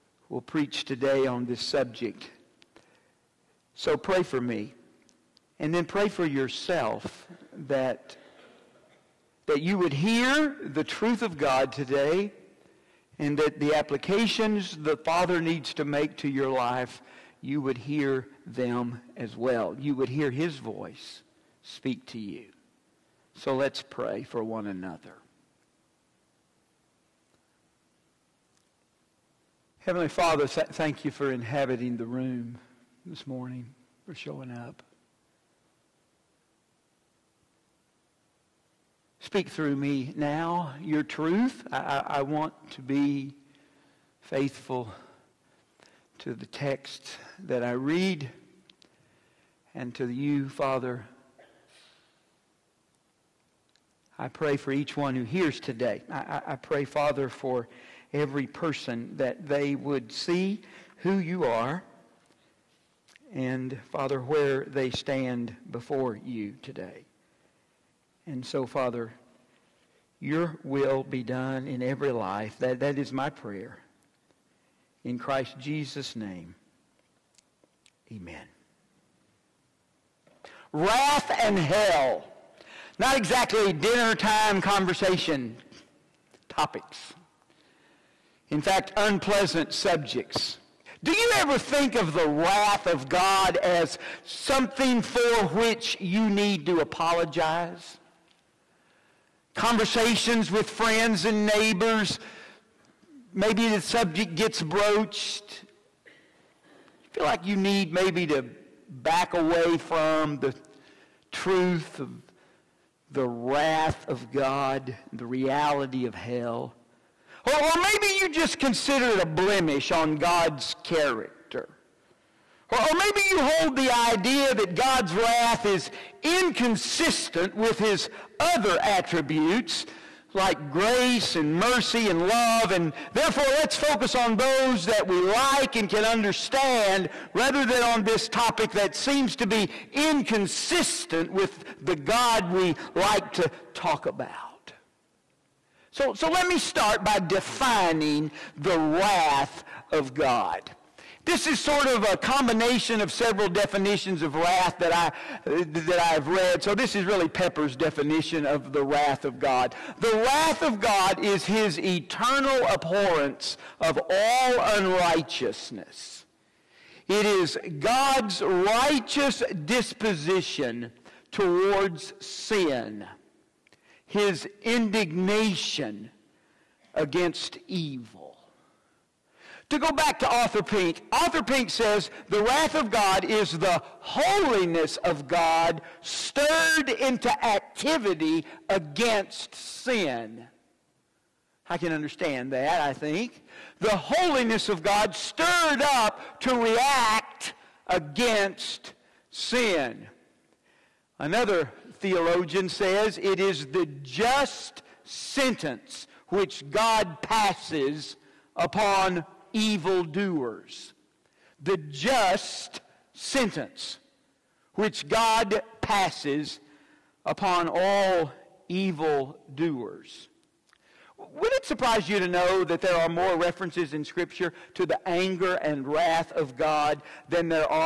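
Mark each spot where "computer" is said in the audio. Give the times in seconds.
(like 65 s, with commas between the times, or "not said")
not said.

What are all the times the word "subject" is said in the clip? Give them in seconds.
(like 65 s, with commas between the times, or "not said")
1 s, 89 s, 103 s.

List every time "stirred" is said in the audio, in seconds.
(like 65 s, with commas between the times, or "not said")
186 s, 195 s.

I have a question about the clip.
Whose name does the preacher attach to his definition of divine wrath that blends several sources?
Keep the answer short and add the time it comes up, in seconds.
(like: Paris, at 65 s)
Pepper, at 157 s.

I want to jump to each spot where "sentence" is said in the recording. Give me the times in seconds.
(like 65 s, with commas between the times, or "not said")
205 s, 213 s.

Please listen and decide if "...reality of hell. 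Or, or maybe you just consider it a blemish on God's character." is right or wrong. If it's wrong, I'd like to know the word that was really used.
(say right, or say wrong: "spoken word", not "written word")
right.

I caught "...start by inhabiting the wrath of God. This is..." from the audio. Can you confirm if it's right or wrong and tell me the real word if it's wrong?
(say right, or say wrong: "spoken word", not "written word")
wrong: "defining", not "inhabiting".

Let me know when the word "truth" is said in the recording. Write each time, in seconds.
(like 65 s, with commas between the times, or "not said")
10 s, 41 s, 111 s.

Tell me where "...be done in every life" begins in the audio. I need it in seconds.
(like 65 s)
71 s.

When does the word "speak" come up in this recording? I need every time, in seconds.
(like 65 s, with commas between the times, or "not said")
21 s, 39 s.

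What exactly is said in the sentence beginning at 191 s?
I can understand that, I think.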